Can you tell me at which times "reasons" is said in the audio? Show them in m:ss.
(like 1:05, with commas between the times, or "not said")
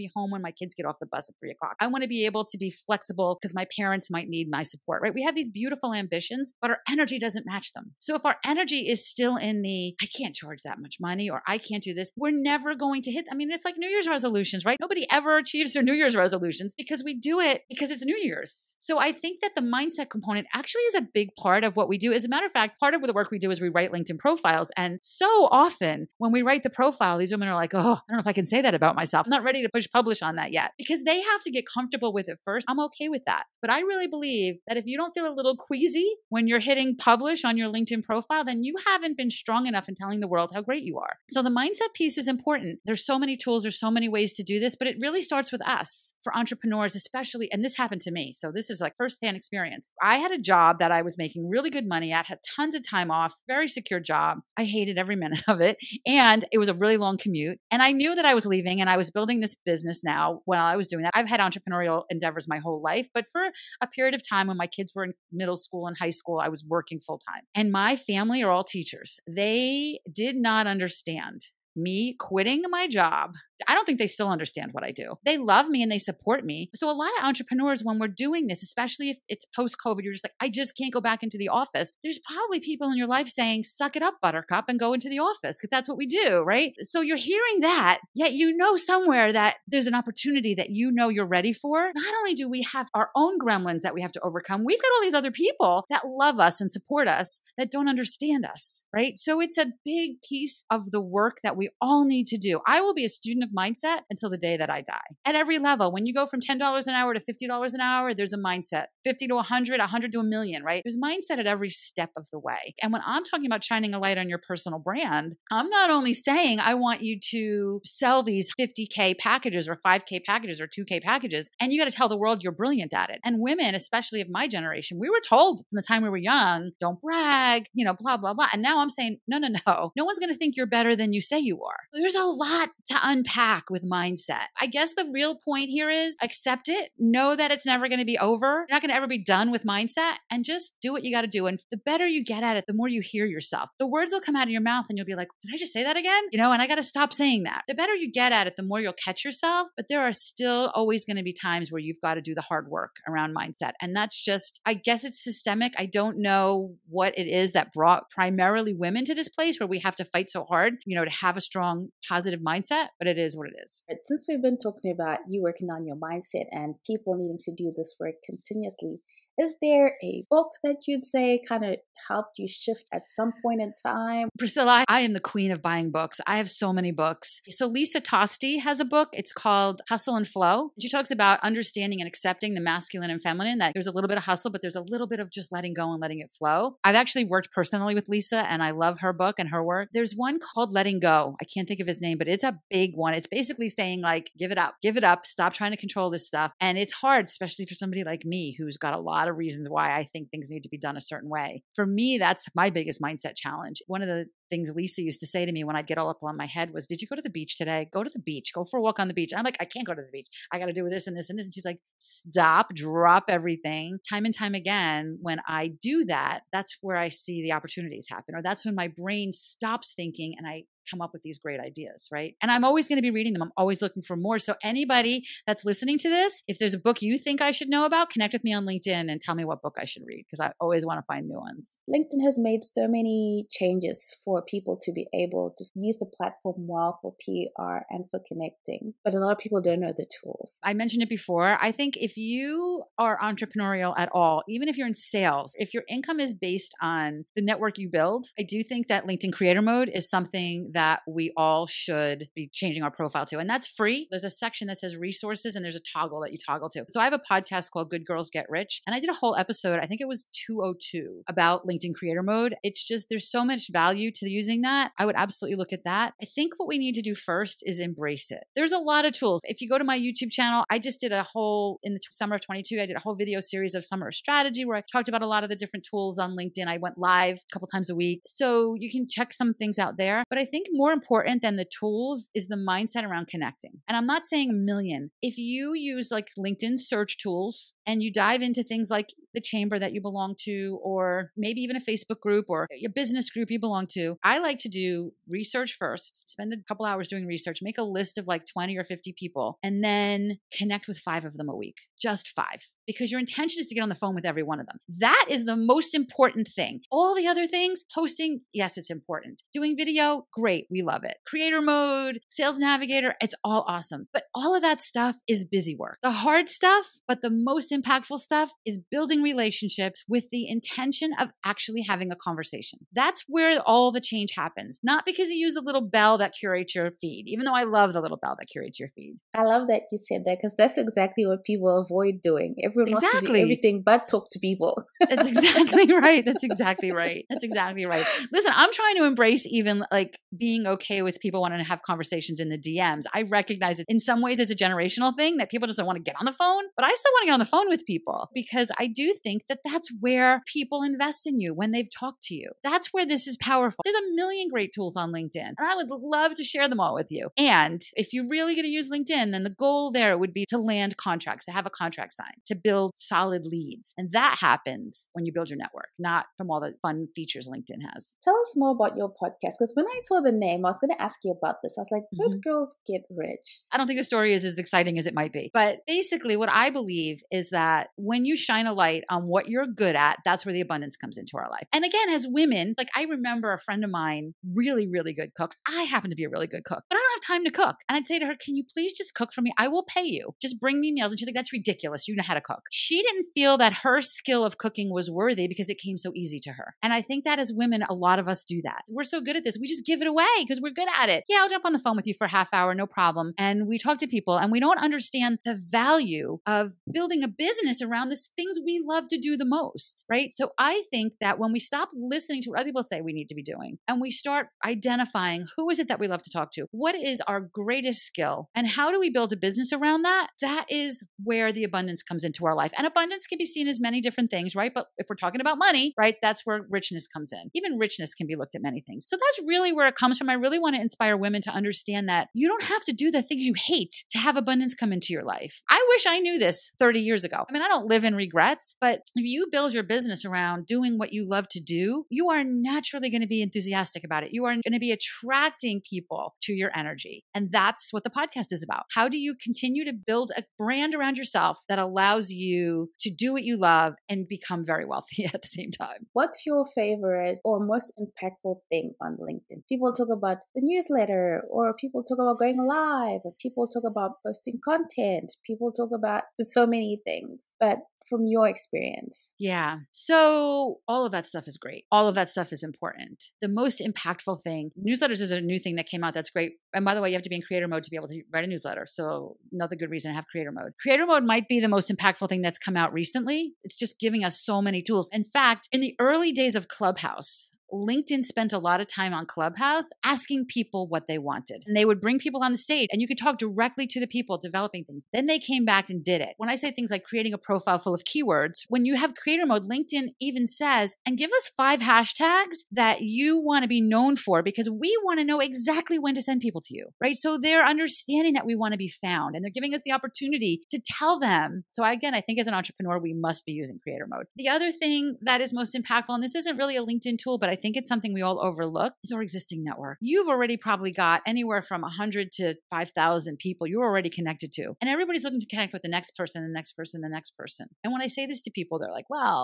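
3:19, 7:59.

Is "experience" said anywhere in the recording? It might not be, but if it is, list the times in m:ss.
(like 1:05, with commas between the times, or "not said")
0:49, 7:48.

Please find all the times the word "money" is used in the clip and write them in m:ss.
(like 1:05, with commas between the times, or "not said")
0:11, 0:51, 7:05.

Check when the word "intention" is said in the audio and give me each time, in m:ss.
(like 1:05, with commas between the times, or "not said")
5:03, 5:20.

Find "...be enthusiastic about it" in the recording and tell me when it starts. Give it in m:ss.
7:23.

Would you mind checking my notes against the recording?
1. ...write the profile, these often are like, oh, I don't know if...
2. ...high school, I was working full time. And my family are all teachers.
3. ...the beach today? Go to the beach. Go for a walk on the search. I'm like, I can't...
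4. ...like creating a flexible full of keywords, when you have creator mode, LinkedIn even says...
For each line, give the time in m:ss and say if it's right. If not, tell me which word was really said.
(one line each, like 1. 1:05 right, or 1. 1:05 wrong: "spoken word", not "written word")
1. 0:26 wrong: "women", not "often"
2. 1:05 right
3. 3:27 wrong: "beach", not "search"
4. 8:16 wrong: "profile", not "flexible".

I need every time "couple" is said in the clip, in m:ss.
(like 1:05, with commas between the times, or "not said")
4:37, 4:56.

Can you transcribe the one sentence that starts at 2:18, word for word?
You're not going to ever be done with mindset and just do what you got to do.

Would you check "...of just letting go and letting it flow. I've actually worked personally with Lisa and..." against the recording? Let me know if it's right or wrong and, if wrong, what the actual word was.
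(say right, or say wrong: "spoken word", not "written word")
right.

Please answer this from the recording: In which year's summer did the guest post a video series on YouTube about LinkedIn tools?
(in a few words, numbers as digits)
2022.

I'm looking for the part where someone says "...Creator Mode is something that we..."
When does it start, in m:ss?
4:09.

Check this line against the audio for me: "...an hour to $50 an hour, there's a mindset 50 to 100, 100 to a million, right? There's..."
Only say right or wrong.
right.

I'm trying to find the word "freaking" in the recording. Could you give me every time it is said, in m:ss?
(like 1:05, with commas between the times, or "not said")
not said.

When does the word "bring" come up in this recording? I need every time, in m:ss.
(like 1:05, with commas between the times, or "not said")
6:30, 8:12.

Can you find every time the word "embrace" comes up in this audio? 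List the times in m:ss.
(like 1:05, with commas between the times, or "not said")
4:27, 5:39.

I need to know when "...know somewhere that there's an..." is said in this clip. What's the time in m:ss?
1:28.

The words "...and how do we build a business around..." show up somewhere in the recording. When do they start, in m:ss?
6:58.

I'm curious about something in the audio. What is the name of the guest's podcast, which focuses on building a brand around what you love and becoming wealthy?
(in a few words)
Good Girls Get Rich.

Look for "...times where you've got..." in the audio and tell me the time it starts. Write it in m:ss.
2:31.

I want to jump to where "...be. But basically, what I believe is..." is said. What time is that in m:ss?
6:15.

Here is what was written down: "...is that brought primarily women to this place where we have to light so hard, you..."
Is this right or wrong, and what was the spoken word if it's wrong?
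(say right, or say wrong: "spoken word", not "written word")
wrong: "fight", not "light".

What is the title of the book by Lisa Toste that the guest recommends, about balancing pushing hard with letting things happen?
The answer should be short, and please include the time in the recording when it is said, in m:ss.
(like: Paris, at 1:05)
Hustle and Flow, at 2:59.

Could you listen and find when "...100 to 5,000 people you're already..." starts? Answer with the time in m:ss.
8:41.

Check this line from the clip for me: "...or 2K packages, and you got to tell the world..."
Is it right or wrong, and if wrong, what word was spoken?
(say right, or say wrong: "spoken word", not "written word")
right.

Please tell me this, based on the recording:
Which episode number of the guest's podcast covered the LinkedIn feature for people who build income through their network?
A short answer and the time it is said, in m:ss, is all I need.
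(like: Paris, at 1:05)
202, at 4:20.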